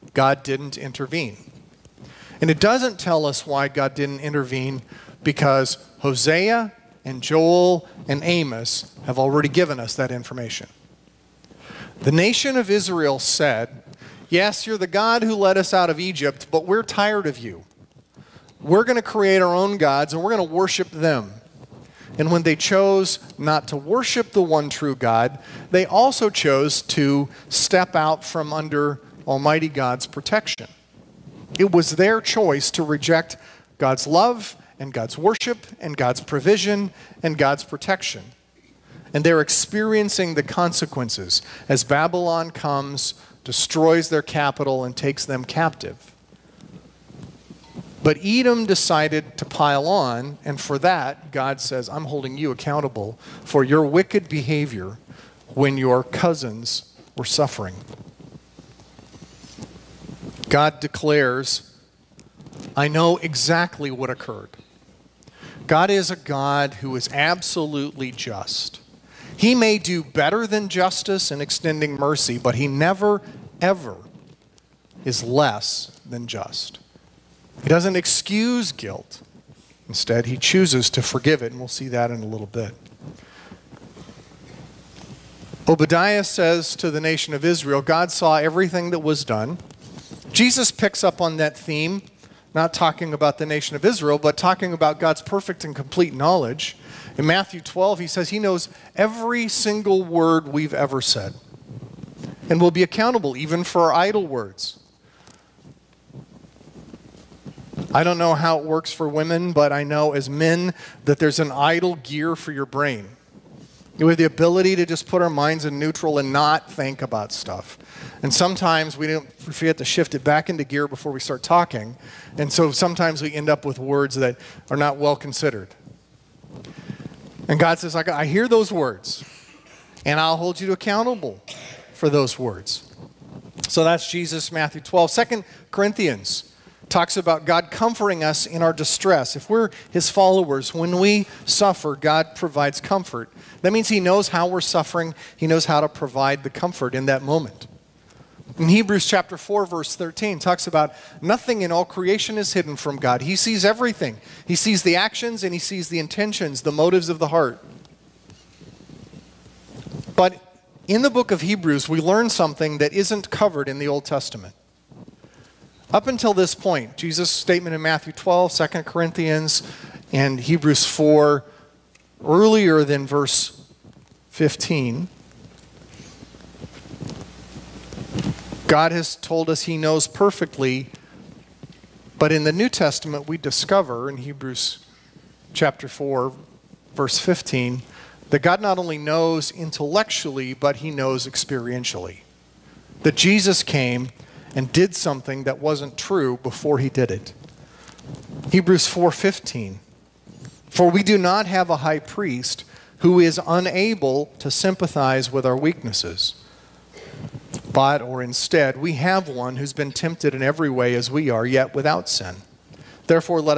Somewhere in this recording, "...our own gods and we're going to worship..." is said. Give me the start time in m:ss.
0:19.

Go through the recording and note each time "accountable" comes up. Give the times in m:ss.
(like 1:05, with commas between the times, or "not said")
0:52, 1:42, 2:10.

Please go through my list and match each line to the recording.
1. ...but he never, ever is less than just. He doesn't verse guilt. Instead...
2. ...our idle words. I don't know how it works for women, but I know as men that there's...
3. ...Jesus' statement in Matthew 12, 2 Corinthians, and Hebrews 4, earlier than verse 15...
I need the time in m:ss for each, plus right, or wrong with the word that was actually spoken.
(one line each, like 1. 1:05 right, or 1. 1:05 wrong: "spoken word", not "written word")
1. 1:12 wrong: "excuse", not "verse"
2. 1:43 right
3. 2:46 right.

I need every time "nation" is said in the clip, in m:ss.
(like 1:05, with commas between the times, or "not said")
0:12, 1:27, 1:33.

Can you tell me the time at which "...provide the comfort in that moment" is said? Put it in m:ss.
2:25.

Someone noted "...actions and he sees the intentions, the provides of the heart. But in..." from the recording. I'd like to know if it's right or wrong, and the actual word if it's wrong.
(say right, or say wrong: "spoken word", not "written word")
wrong: "motives", not "provides".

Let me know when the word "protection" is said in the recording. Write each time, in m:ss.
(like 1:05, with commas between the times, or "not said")
0:30, 0:37.